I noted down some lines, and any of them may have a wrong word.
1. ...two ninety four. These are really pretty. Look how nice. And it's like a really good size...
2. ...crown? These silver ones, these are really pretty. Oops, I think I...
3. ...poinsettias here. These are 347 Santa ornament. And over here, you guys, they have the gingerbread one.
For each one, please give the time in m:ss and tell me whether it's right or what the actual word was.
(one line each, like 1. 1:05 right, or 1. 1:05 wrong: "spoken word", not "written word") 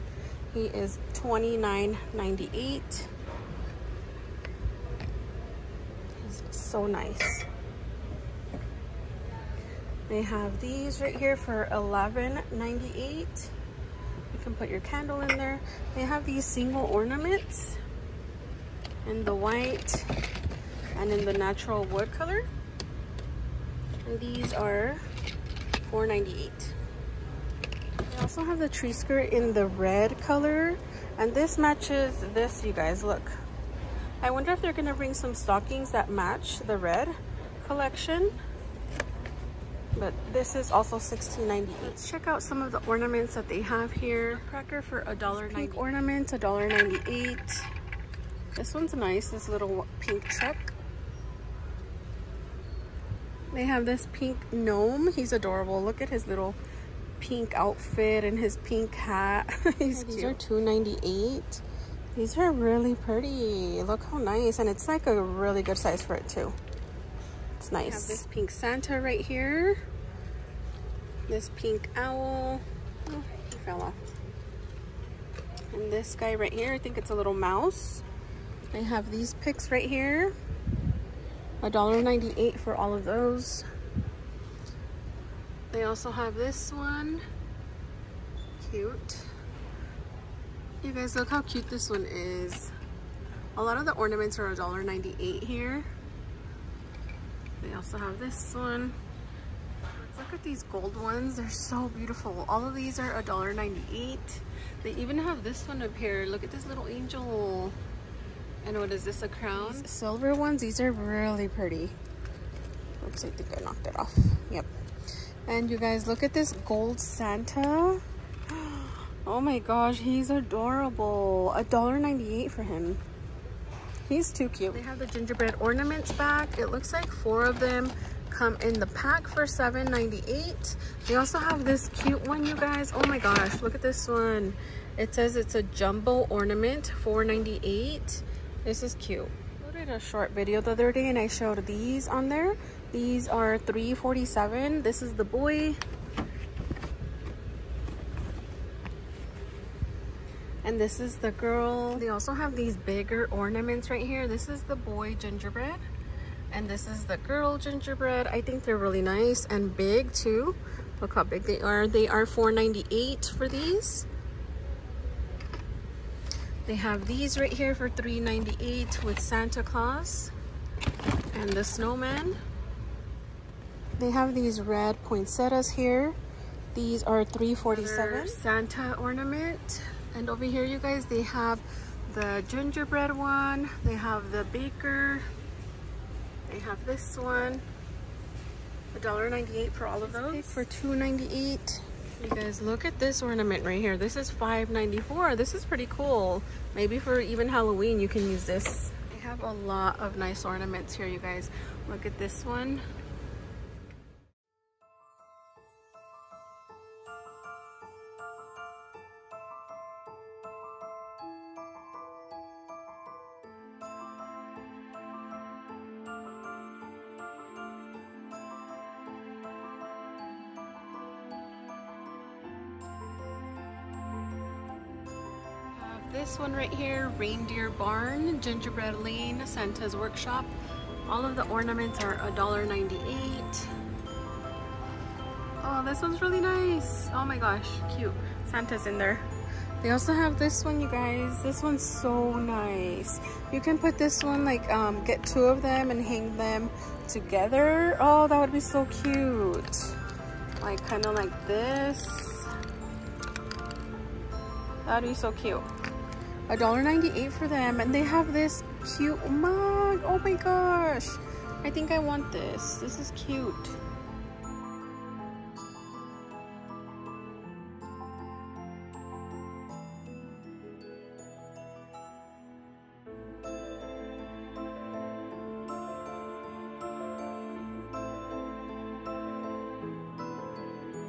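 1. 1:00 wrong: "eight", not "four"
2. 1:49 right
3. 2:55 right.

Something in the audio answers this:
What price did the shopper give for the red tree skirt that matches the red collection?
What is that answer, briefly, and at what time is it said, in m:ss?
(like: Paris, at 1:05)
$16.98, at 0:40.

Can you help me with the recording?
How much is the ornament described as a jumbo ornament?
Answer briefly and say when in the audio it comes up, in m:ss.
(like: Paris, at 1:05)
$4.98, at 2:17.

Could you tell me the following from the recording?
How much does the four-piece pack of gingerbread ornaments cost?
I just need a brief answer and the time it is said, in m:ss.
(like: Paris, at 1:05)
$7.98, at 2:09.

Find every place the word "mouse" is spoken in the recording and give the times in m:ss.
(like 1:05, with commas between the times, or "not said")
1:17.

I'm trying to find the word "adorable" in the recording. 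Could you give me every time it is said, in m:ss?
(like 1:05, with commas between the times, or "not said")
0:55, 2:00.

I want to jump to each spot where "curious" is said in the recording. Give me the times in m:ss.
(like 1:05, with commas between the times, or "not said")
not said.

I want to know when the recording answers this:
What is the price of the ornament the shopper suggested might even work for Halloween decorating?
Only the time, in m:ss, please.
3:14.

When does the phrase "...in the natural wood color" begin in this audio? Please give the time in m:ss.
0:21.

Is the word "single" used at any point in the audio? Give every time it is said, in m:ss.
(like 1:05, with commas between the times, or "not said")
0:16.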